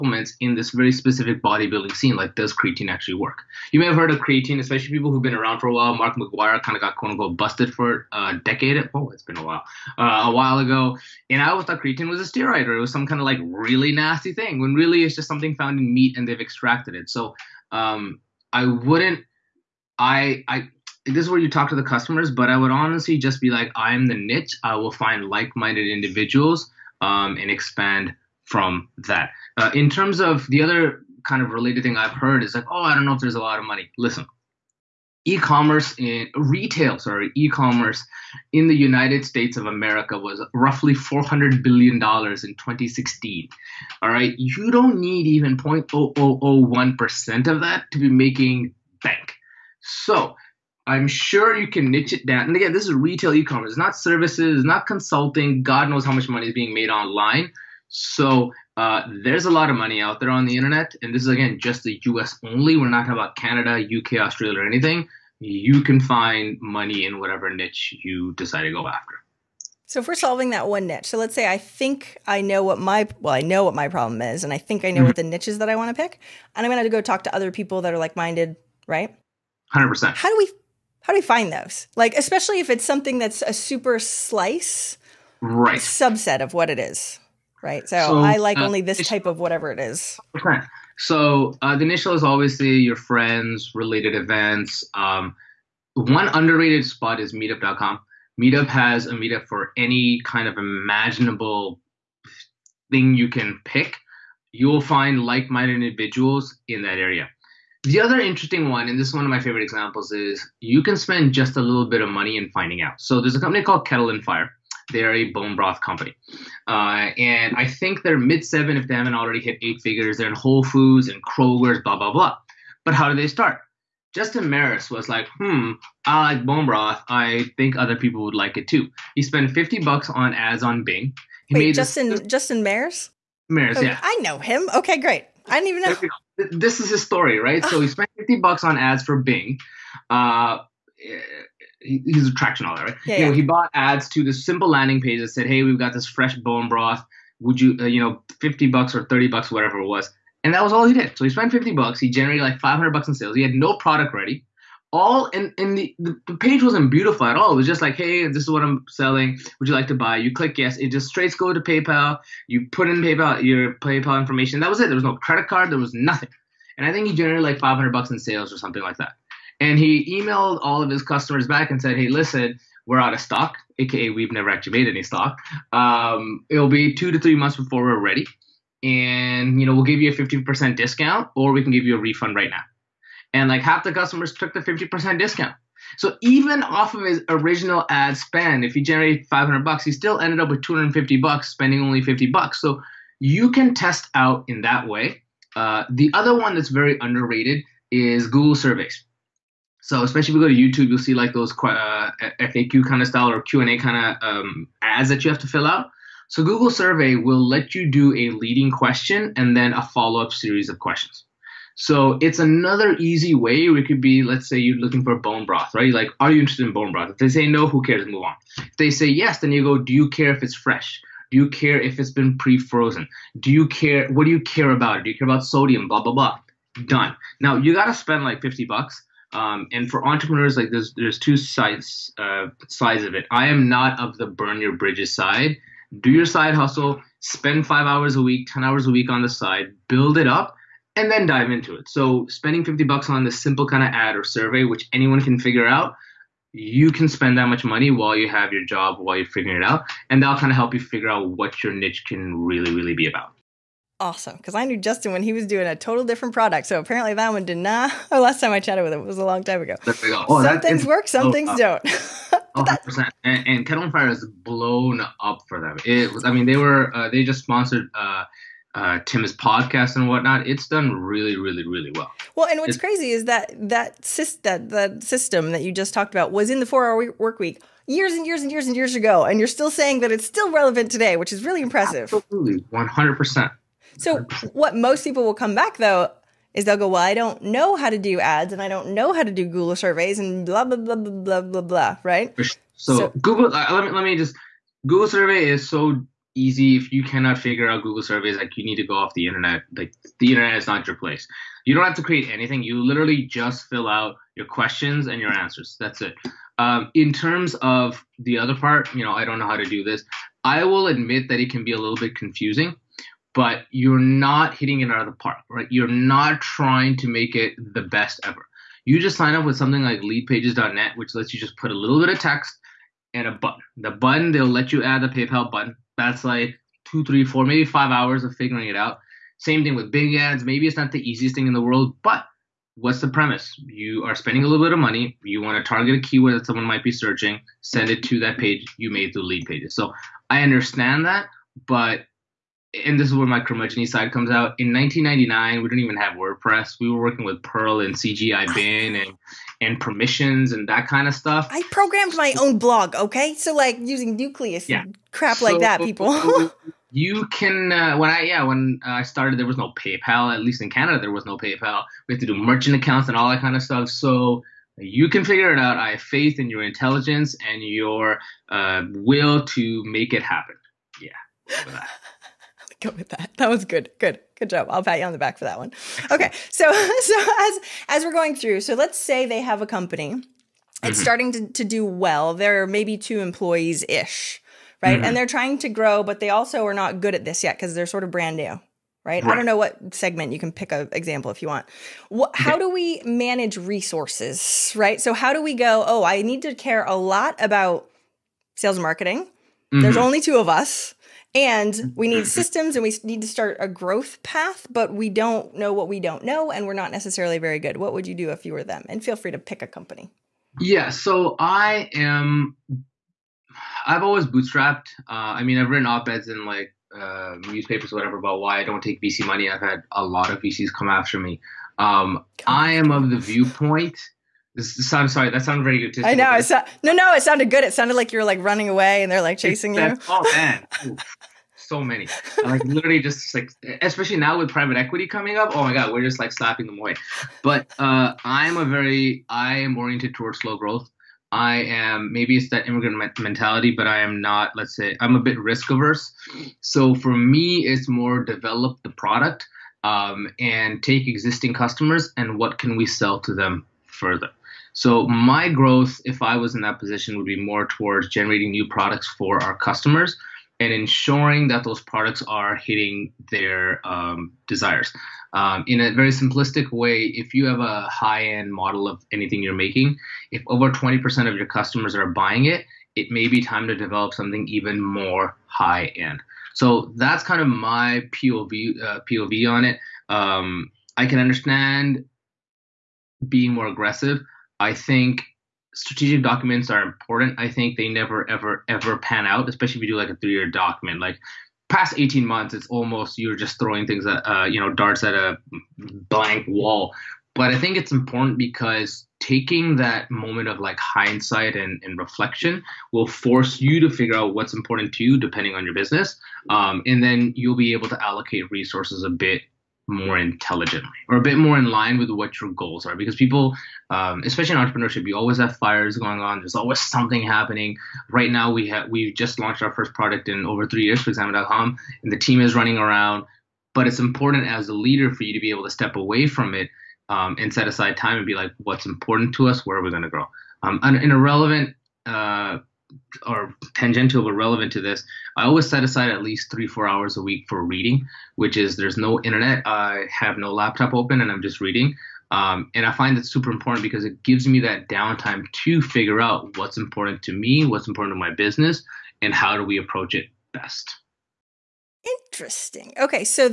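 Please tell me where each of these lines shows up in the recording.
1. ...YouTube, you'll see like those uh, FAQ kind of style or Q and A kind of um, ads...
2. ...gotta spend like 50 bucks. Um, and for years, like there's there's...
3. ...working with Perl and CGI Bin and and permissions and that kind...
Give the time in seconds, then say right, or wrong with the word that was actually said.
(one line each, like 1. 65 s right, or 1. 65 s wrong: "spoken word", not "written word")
1. 200 s right
2. 227 s wrong: "entrepreneurs", not "years"
3. 347 s right.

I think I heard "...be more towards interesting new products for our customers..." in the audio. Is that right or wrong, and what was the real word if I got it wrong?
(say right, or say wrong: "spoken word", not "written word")
wrong: "generating", not "interesting".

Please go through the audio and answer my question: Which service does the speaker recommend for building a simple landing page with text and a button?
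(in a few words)
leadpages.net.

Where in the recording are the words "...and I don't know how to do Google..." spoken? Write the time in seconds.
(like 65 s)
288 s.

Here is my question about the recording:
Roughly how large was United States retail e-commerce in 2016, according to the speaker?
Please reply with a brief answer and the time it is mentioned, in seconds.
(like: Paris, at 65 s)
400 billion dollars, at 40 s.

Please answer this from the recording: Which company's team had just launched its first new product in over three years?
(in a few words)
Examine.com.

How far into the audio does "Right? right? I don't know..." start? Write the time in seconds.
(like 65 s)
389 s.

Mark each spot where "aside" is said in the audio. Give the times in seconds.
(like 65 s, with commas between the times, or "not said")
527 s, 535 s.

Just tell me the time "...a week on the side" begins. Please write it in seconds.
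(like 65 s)
238 s.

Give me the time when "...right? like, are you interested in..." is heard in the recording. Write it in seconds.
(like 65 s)
215 s.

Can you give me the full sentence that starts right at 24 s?
I will find like minded individuals um, and expand from that.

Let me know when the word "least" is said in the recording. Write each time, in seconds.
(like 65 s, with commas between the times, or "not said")
360 s, 536 s.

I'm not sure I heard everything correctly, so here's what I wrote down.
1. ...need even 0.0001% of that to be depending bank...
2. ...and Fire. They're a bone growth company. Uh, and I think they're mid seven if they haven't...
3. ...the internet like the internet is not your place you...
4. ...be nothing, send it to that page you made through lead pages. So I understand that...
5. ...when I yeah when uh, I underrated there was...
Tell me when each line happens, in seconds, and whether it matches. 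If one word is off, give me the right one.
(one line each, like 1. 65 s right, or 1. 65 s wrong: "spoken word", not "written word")
1. 44 s wrong: "making", not "depending"
2. 114 s wrong: "broth", not "growth"
3. 299 s right
4. 336 s wrong: "searching", not "nothing"
5. 357 s wrong: "started", not "underrated".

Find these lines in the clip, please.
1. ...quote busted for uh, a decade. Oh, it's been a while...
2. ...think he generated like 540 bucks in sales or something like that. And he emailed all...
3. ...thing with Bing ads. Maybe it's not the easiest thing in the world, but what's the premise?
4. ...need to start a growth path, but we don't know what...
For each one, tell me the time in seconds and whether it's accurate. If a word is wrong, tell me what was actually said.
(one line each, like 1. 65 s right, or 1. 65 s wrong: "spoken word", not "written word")
1. 7 s wrong: "unquote", not "quote"
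2. 166 s wrong: "500", not "540"
3. 329 s right
4. 403 s right.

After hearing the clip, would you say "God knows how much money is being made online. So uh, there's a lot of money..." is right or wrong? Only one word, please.
right.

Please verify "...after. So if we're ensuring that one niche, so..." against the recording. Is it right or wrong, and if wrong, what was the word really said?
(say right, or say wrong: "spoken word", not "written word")
wrong: "solving", not "ensuring".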